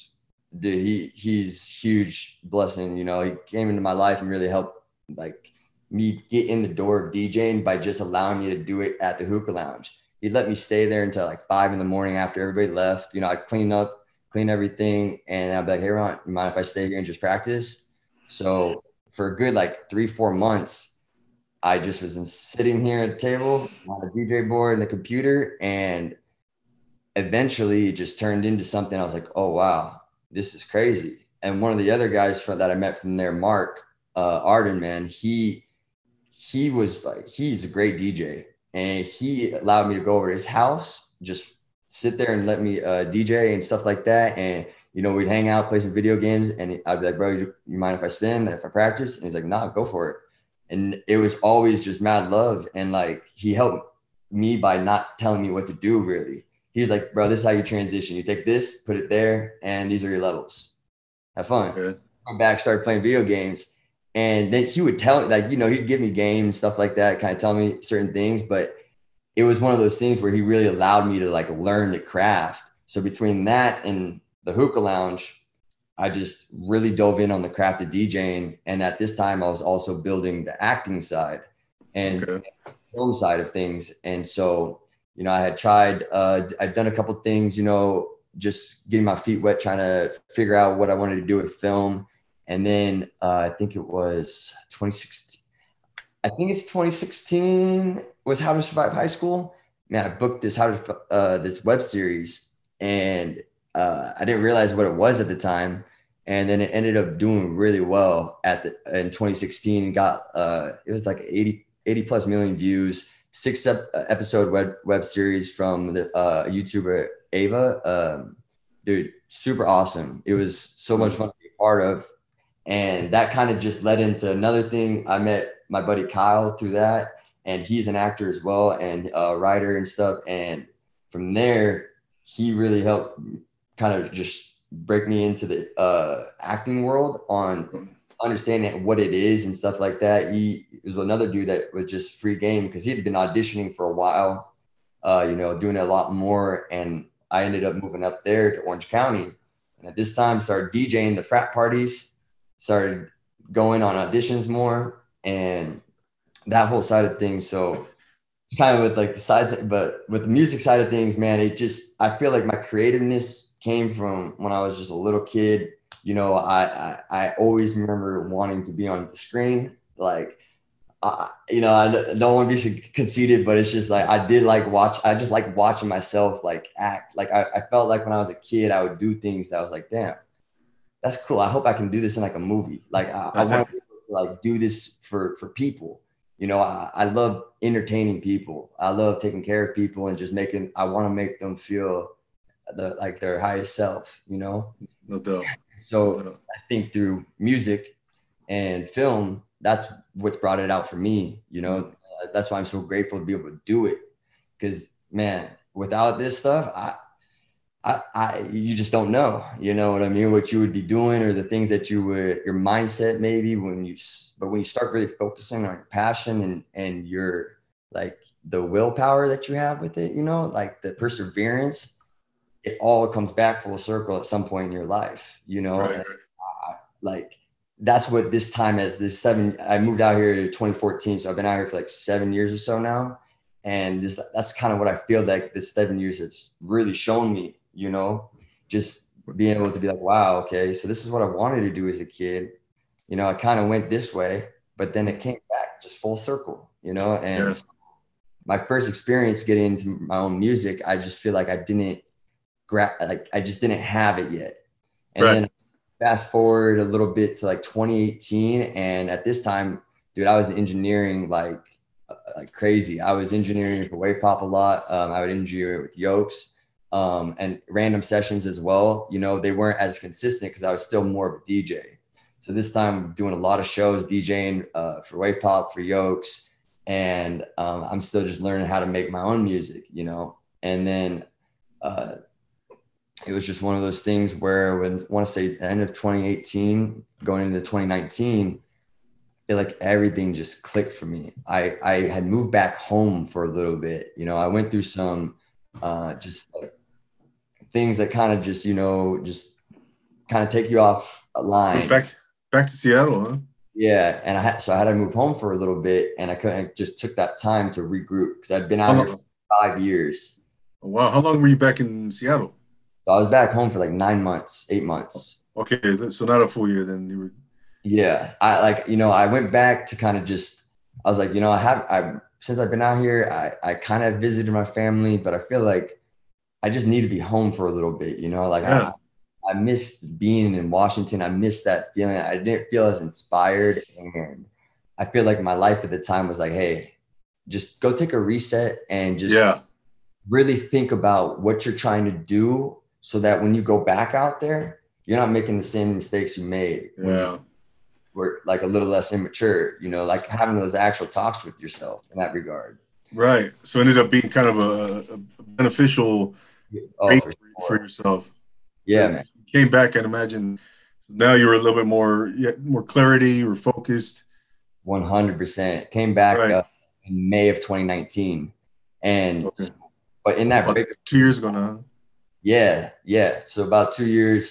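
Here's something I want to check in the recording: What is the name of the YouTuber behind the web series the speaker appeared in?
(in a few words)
Ava.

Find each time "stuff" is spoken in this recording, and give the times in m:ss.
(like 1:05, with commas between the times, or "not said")
0:43, 1:06, 2:09, 2:19, 3:26.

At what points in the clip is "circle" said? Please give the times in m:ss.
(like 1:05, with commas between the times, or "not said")
3:43, 4:06.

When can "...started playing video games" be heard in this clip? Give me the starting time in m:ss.
1:02.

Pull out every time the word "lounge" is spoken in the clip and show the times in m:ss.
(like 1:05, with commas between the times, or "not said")
0:09, 1:14.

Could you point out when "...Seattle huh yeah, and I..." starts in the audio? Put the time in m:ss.
5:02.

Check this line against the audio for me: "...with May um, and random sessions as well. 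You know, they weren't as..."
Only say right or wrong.
wrong.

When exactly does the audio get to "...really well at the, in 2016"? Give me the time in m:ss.
1:47.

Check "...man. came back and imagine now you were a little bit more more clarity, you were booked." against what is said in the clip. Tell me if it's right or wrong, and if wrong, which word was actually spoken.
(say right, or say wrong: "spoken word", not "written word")
wrong: "focused", not "booked".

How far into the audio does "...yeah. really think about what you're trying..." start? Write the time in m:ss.
5:39.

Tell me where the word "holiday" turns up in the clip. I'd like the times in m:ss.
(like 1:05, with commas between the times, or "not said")
not said.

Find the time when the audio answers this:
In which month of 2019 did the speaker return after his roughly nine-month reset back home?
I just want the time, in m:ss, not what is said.
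6:07.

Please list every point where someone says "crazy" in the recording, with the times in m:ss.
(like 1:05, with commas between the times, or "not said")
0:30, 4:22.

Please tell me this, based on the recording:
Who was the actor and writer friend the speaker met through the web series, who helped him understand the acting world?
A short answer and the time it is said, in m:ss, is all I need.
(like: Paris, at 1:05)
Kyle, at 2:06.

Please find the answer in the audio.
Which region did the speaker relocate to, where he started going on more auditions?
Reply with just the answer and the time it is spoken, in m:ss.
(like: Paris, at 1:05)
Orange County, at 2:28.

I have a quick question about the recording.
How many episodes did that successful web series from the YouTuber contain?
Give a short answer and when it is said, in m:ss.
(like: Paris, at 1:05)
6, at 1:53.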